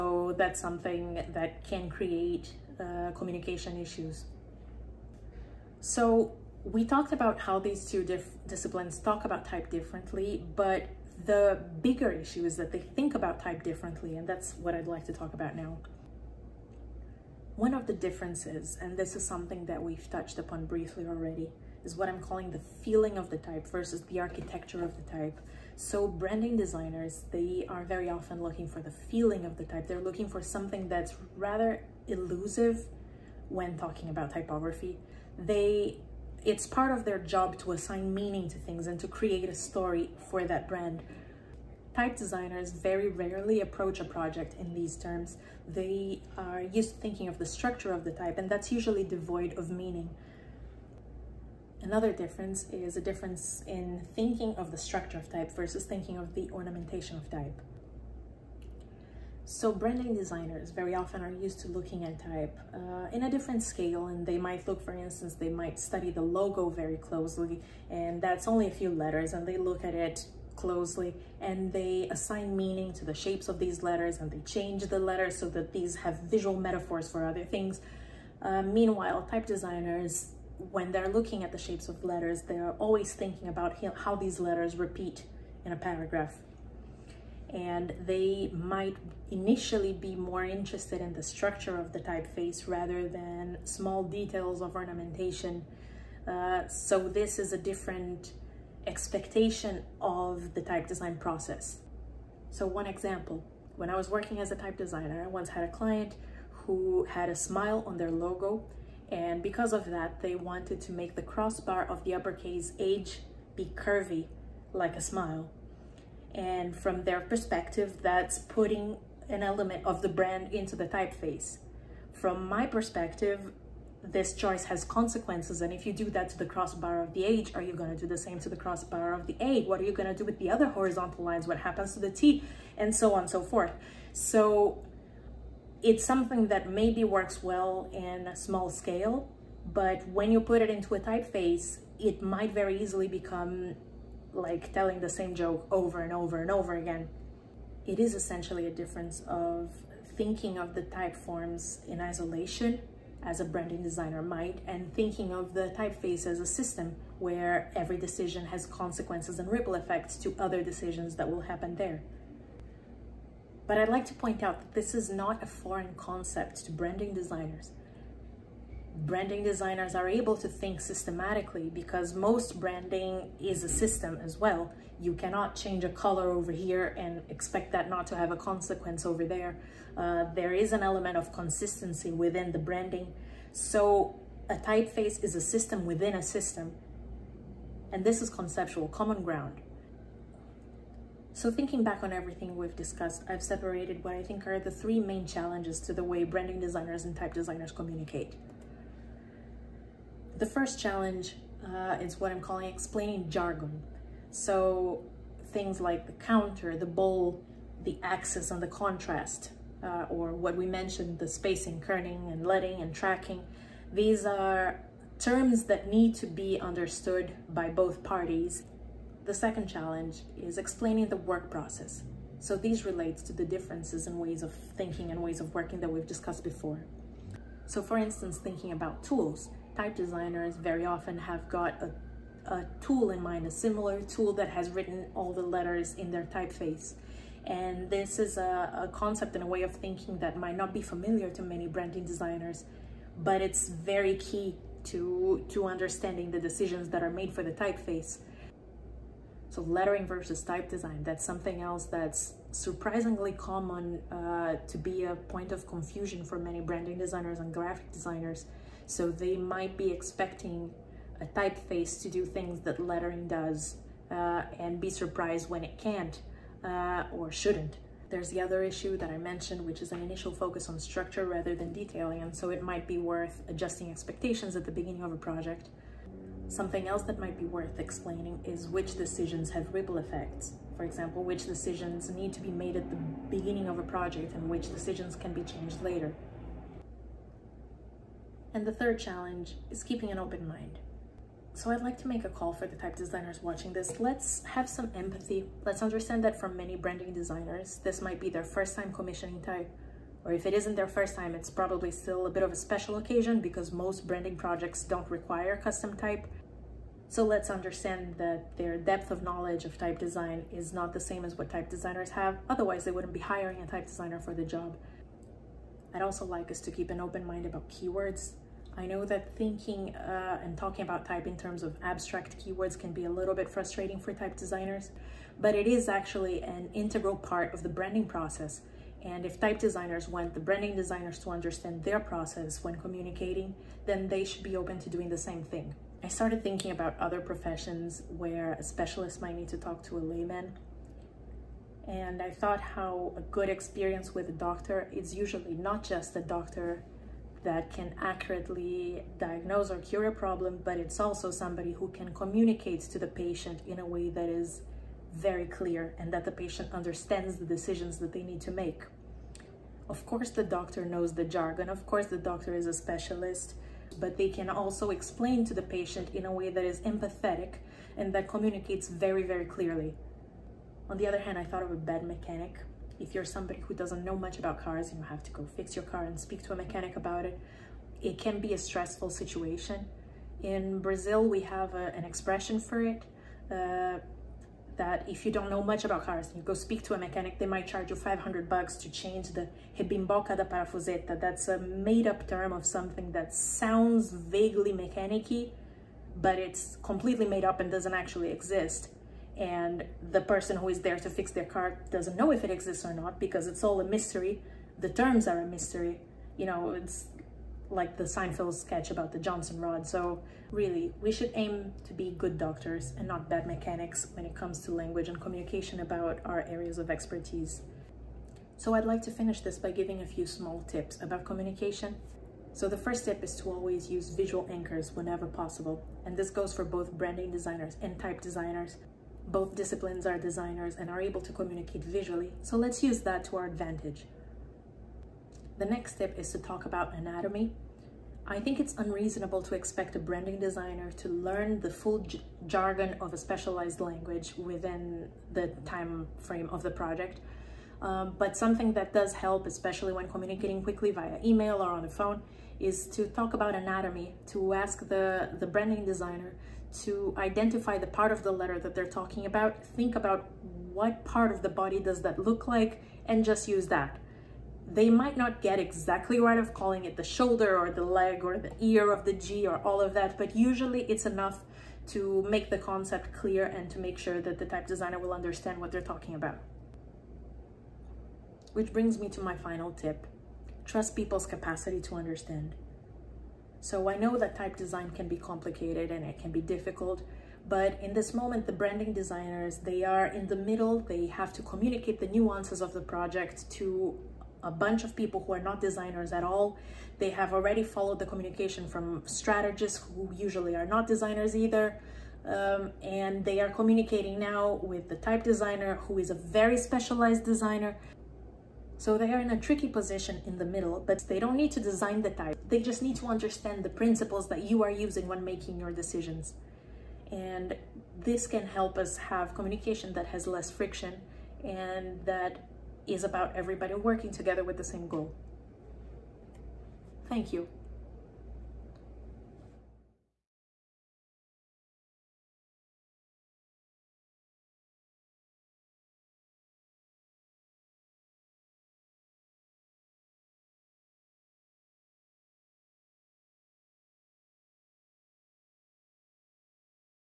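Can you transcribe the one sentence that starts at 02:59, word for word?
Uh, there is an element of consistency within the branding.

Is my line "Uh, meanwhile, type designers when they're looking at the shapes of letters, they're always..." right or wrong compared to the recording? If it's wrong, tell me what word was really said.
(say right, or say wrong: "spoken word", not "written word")
right.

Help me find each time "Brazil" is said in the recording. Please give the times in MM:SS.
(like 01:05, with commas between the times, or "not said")
06:20.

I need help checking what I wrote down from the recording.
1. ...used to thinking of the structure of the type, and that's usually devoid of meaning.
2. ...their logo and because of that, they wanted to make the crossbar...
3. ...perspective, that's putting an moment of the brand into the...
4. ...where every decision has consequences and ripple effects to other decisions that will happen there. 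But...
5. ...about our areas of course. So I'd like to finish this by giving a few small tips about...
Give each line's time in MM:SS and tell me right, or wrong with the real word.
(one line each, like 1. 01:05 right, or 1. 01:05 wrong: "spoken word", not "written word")
1. 00:46 right
2. 01:47 right
3. 01:57 wrong: "element", not "moment"
4. 02:37 right
5. 06:55 wrong: "expertise", not "course".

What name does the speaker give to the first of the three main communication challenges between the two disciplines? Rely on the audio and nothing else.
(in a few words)
explaining jargon.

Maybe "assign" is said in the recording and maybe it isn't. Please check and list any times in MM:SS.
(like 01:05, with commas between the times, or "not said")
00:37, 01:12.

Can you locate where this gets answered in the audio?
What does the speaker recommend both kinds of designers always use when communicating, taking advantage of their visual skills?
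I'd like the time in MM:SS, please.
07:04.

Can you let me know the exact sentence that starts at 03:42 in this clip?
So these relates to the differences in ways of thinking and ways of working that we've discussed before.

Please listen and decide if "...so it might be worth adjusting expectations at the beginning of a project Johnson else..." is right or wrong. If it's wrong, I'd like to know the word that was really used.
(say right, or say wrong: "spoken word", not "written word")
wrong: "Something", not "Johnson".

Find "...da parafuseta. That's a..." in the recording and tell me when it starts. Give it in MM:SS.
06:30.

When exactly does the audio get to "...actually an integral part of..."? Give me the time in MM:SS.
05:25.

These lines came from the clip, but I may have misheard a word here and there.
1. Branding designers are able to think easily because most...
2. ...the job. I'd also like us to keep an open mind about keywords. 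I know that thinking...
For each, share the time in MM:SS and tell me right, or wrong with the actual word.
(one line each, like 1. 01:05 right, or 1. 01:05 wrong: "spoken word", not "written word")
1. 02:49 wrong: "systematically", not "easily"
2. 05:14 right.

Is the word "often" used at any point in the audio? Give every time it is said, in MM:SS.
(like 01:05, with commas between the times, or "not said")
00:28, 01:00, 03:50.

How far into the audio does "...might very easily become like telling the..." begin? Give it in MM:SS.
02:22.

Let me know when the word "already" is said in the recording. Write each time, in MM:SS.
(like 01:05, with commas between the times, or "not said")
00:21, 08:17.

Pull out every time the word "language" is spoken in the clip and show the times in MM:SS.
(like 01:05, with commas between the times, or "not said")
06:54, 07:23.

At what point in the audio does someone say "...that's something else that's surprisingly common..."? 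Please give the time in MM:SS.
04:11.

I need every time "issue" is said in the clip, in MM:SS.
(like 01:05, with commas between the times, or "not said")
00:03, 00:12, 04:28.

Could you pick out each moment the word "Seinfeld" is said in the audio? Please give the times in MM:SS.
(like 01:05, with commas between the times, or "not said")
06:48.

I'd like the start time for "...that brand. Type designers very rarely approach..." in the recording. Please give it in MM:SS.
00:40.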